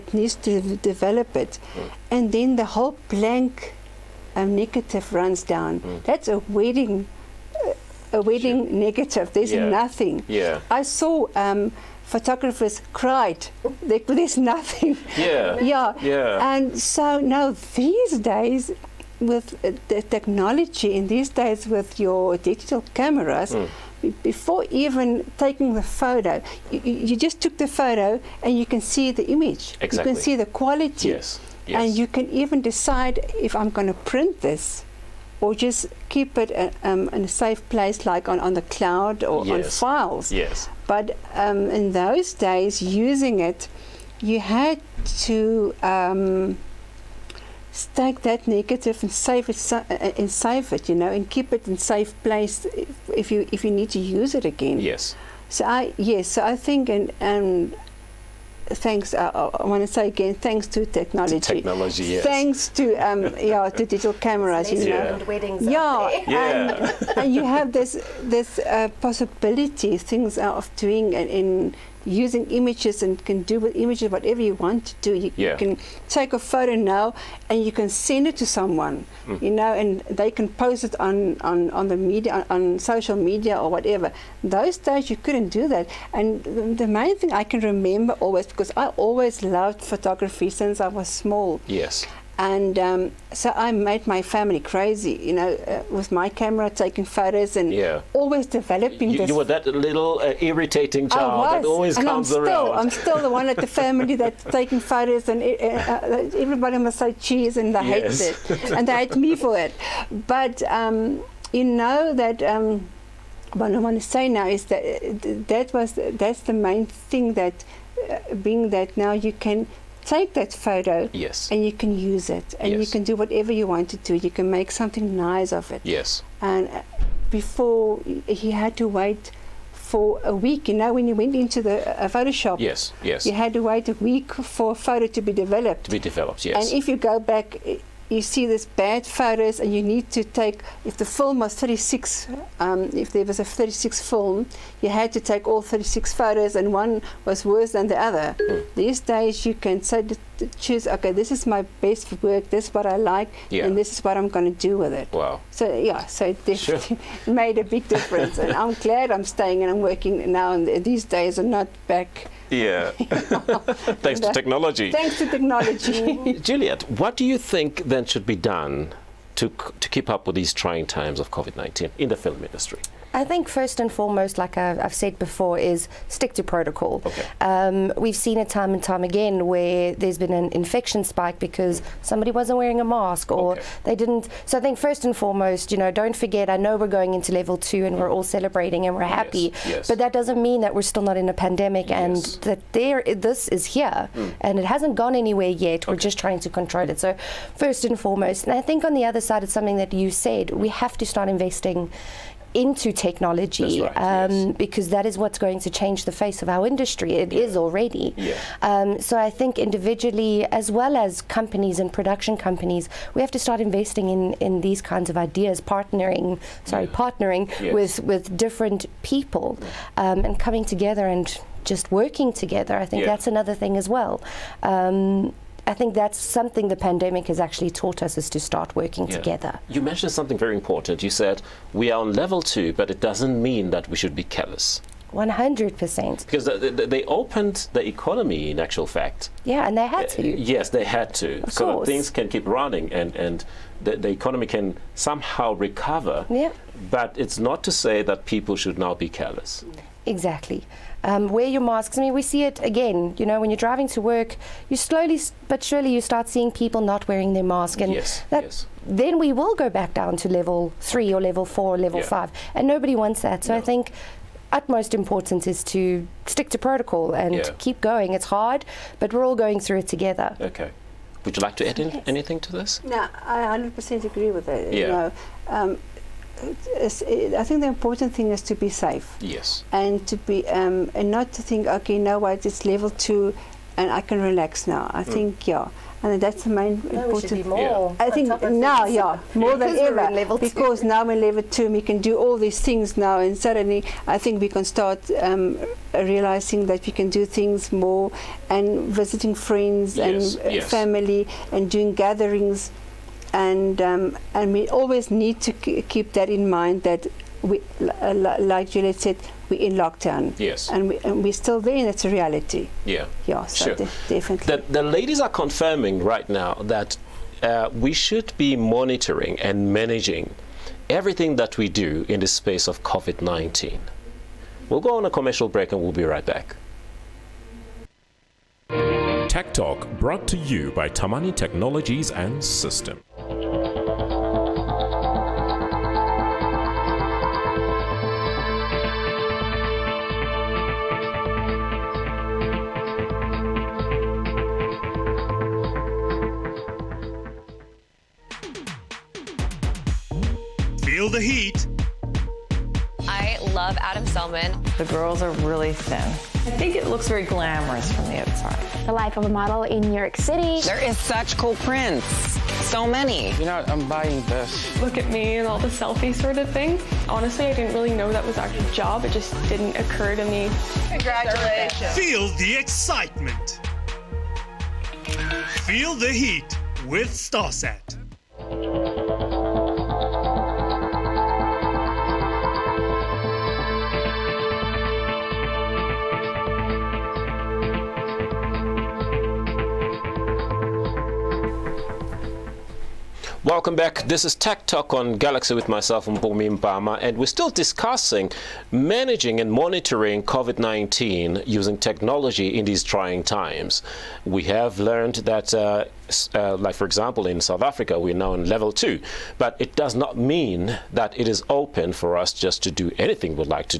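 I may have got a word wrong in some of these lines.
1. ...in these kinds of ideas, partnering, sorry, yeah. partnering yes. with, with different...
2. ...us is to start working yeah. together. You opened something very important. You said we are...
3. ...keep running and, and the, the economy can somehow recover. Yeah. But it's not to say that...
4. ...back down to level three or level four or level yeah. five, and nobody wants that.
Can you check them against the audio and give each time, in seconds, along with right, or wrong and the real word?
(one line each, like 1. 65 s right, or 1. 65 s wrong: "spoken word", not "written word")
1. 214 s right
2. 228 s wrong: "mentioned", not "opened"
3. 242 s right
4. 259 s right.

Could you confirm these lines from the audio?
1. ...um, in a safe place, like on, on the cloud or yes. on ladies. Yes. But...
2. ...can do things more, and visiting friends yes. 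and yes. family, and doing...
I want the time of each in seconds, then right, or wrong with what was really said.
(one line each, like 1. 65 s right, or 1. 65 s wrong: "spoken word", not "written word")
1. 36 s wrong: "files", not "ladies"
2. 296 s right.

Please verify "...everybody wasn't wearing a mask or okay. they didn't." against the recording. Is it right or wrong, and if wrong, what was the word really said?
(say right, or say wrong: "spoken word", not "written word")
wrong: "somebody", not "everybody".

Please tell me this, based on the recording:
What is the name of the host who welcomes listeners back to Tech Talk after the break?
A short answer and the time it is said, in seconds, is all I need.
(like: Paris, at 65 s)
Mpumi Mpama, at 396 s.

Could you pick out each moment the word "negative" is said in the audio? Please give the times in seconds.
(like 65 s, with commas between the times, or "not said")
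4 s, 8 s, 48 s.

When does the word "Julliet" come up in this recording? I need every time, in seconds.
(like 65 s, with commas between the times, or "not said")
166 s, 308 s.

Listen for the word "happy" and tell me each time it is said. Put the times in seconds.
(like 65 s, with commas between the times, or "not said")
189 s.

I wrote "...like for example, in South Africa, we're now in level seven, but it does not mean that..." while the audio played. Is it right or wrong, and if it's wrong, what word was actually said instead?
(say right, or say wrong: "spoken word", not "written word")
wrong: "two", not "seven".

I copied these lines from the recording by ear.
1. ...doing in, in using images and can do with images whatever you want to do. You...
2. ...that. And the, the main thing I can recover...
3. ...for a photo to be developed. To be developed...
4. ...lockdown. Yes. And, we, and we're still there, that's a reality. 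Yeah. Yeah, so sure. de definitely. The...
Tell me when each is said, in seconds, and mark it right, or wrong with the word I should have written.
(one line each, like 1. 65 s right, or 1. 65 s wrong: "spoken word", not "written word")
1. 70 s right
2. 85 s wrong: "remember", not "recover"
3. 134 s right
4. 309 s right.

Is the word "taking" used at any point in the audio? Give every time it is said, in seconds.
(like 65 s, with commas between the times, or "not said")
25 s, 96 s, 104 s.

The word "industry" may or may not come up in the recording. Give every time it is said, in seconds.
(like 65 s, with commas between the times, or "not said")
172 s, 206 s.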